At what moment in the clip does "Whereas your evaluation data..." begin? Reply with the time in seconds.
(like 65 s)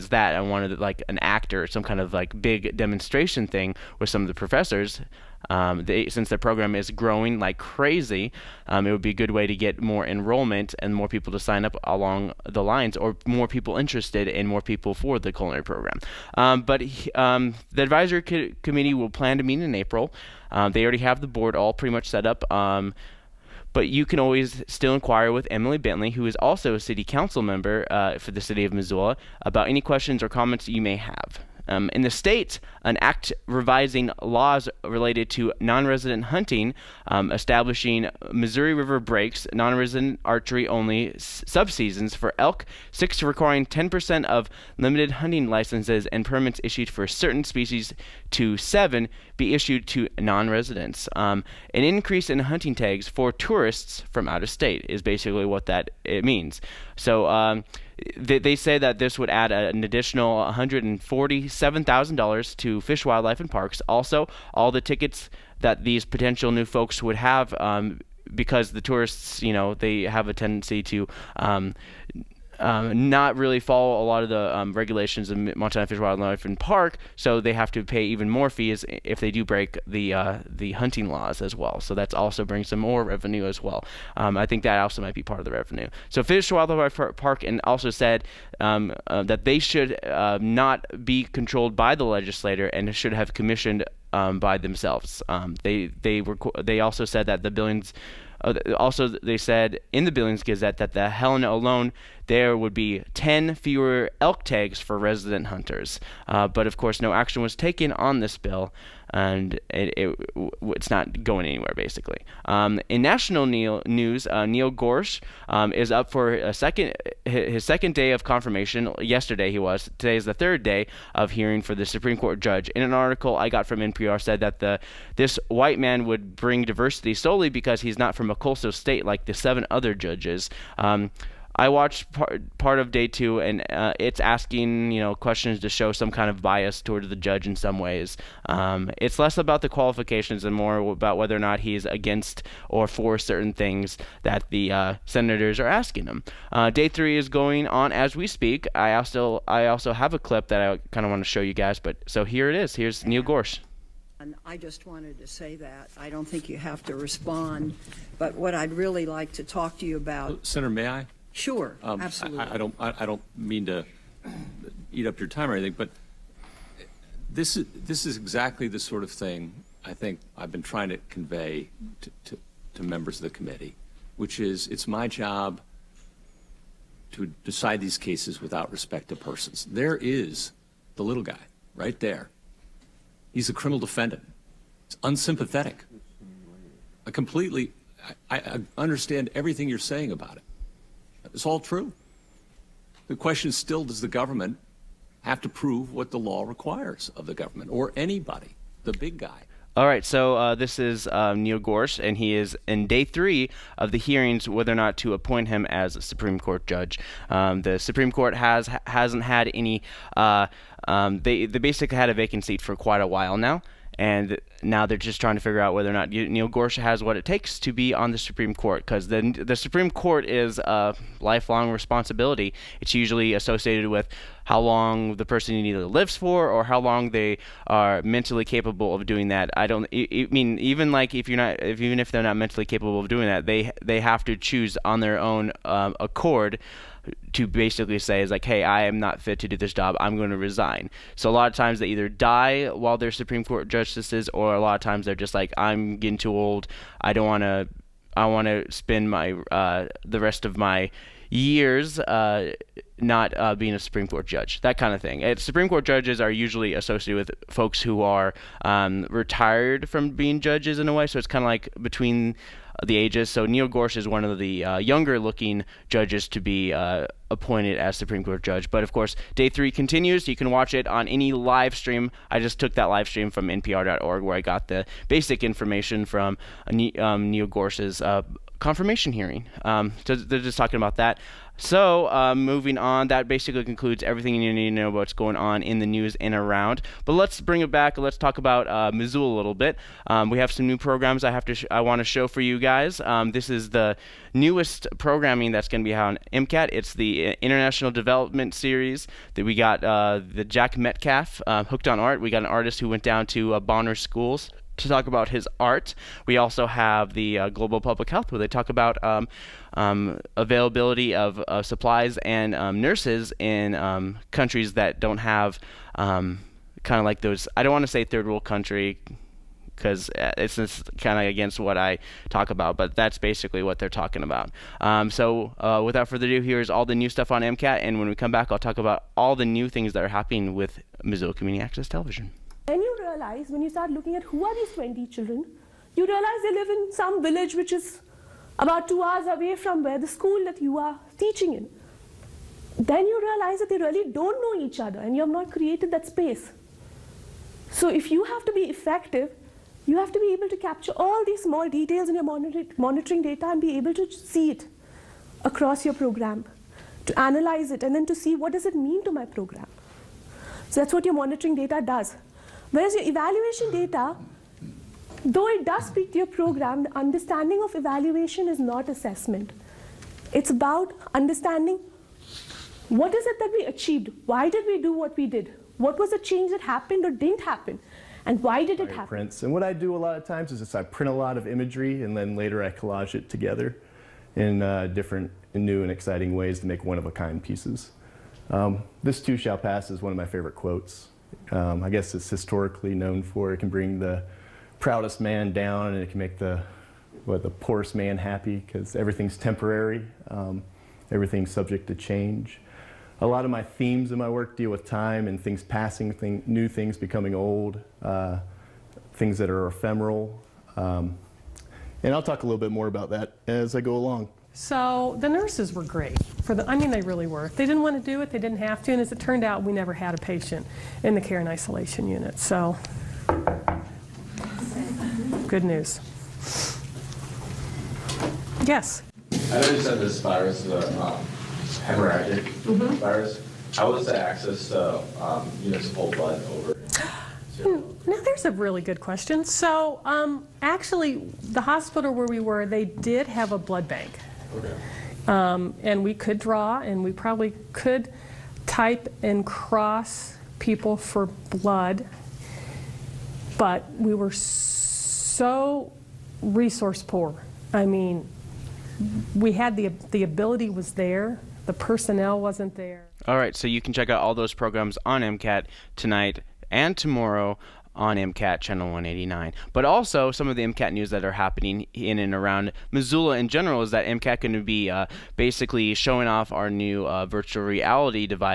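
362 s.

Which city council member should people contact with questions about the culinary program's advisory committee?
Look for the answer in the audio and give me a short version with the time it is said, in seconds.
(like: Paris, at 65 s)
Emily Bentley, at 25 s.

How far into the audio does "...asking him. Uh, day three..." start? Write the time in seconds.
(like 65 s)
145 s.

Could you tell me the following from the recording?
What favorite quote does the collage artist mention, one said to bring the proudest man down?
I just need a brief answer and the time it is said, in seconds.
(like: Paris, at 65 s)
This too shall pass, at 389 s.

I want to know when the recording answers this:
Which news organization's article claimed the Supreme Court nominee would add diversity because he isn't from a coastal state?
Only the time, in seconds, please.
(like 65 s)
123 s.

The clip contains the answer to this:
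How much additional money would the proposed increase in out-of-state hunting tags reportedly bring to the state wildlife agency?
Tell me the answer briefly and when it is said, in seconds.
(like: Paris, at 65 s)
$147,000, at 60 s.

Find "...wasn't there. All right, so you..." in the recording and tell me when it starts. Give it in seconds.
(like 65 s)
462 s.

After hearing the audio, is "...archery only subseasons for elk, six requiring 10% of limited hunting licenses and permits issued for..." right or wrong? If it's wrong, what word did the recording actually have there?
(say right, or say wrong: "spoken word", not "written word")
right.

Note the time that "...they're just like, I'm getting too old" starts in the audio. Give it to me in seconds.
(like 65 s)
245 s.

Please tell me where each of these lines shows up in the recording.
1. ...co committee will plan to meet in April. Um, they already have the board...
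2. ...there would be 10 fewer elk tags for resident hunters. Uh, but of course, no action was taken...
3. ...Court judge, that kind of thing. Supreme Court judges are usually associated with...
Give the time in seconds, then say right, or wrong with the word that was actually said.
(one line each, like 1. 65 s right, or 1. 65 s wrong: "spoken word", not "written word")
1. 18 s right
2. 102 s right
3. 254 s right.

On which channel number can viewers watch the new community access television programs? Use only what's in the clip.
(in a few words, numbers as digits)
189.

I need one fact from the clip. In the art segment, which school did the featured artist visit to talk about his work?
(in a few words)
Bonner Schools.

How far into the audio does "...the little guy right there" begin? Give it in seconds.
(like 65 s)
180 s.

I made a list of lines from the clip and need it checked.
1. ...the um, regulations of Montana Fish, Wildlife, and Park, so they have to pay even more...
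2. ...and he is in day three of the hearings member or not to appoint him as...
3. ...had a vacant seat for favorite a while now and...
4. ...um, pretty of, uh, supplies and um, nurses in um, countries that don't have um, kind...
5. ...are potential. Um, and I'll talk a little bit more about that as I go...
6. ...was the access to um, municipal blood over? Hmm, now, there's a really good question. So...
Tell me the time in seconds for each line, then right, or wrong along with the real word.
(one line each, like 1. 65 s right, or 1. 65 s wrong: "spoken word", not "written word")
1. 74 s right
2. 202 s wrong: "whether", not "member"
3. 211 s wrong: "quite", not "favorite"
4. 309 s wrong: "availability", not "pretty"
5. 409 s wrong: "ephemeral", not "potential"
6. 433 s right.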